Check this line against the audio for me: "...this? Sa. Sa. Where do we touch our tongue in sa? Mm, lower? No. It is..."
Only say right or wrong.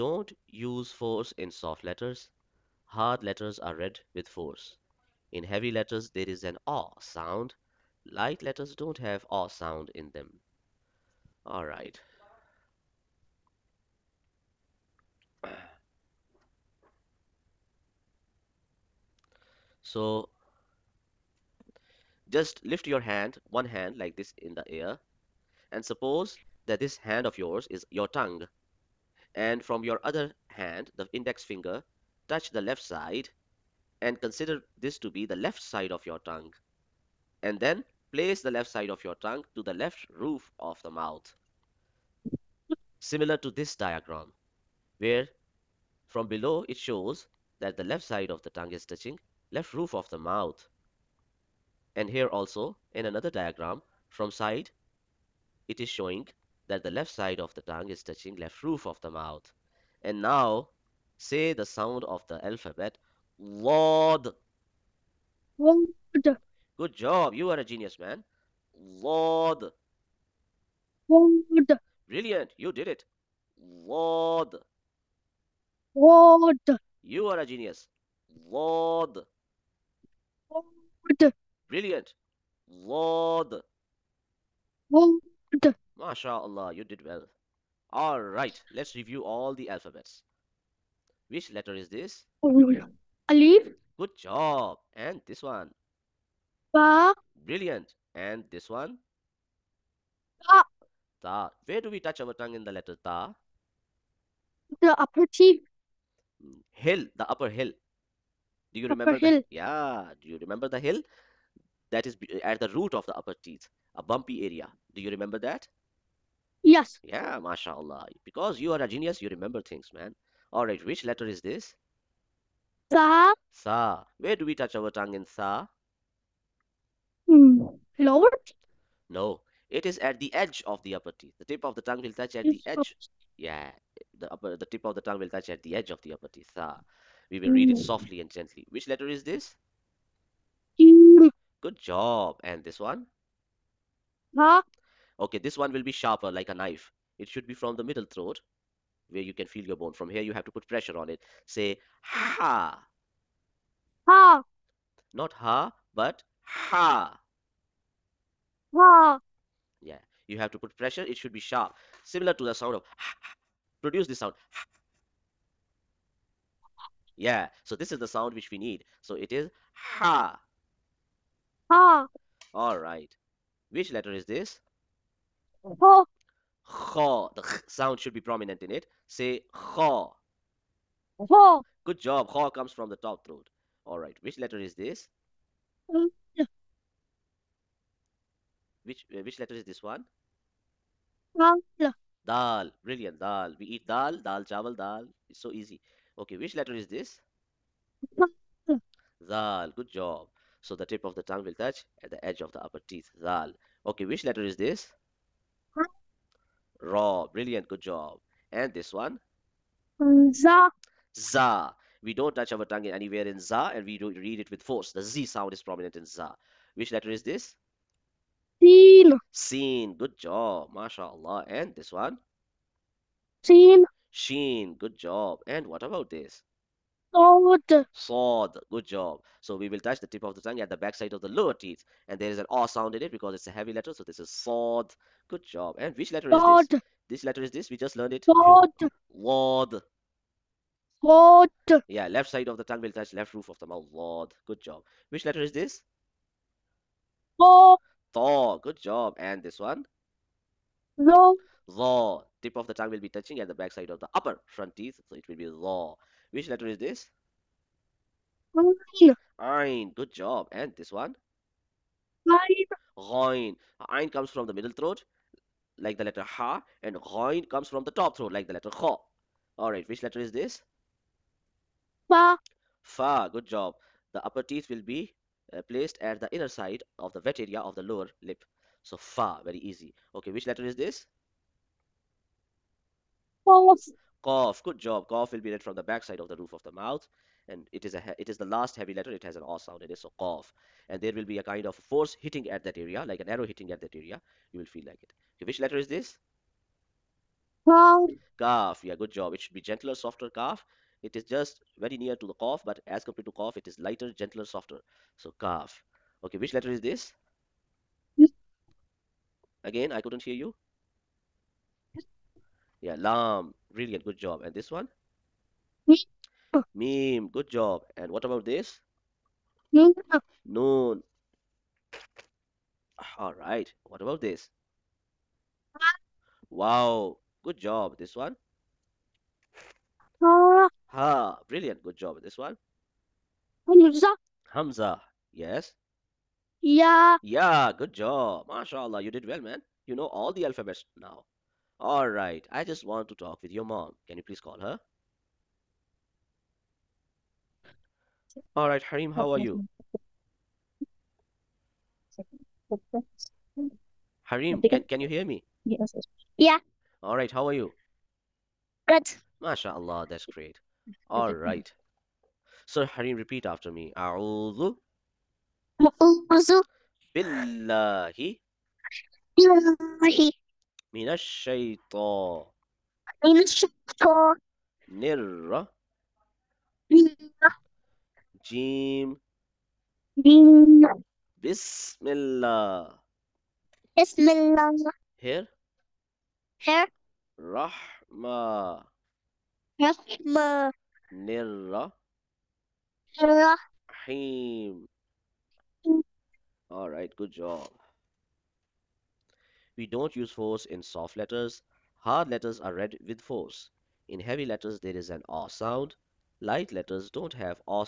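right.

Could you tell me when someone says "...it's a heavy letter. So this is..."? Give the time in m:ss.
3:53.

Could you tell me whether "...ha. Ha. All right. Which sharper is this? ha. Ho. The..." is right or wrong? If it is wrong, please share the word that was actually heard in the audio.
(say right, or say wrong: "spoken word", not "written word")
wrong: "letter", not "sharper".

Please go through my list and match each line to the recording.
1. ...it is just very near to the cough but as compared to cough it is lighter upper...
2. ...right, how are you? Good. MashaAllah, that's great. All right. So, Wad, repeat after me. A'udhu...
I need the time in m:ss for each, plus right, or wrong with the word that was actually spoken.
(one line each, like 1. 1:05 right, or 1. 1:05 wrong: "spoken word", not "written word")
1. 5:01 wrong: "gentler", not "upper"
2. 5:57 wrong: "Hareem", not "Wad".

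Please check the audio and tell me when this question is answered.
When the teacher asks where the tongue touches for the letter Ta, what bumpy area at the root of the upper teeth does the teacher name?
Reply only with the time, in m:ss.
1:47.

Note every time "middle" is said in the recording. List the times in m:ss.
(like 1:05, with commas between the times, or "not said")
2:27, 4:24.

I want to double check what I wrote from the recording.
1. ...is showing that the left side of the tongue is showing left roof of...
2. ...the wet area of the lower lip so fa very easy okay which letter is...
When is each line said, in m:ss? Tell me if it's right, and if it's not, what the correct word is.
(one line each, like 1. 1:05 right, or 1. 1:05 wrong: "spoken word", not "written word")
1. 0:55 wrong: "touching", not "showing"
2. 4:37 right.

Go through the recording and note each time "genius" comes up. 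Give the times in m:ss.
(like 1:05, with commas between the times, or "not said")
1:07, 1:17, 1:58.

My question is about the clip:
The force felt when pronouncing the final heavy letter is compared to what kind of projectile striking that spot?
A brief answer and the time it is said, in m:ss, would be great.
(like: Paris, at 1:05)
an arrow, at 4:53.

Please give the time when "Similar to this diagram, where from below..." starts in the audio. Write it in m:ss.
0:42.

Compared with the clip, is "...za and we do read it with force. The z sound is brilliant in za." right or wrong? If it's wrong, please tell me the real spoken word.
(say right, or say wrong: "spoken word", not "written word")
wrong: "prominent", not "brilliant".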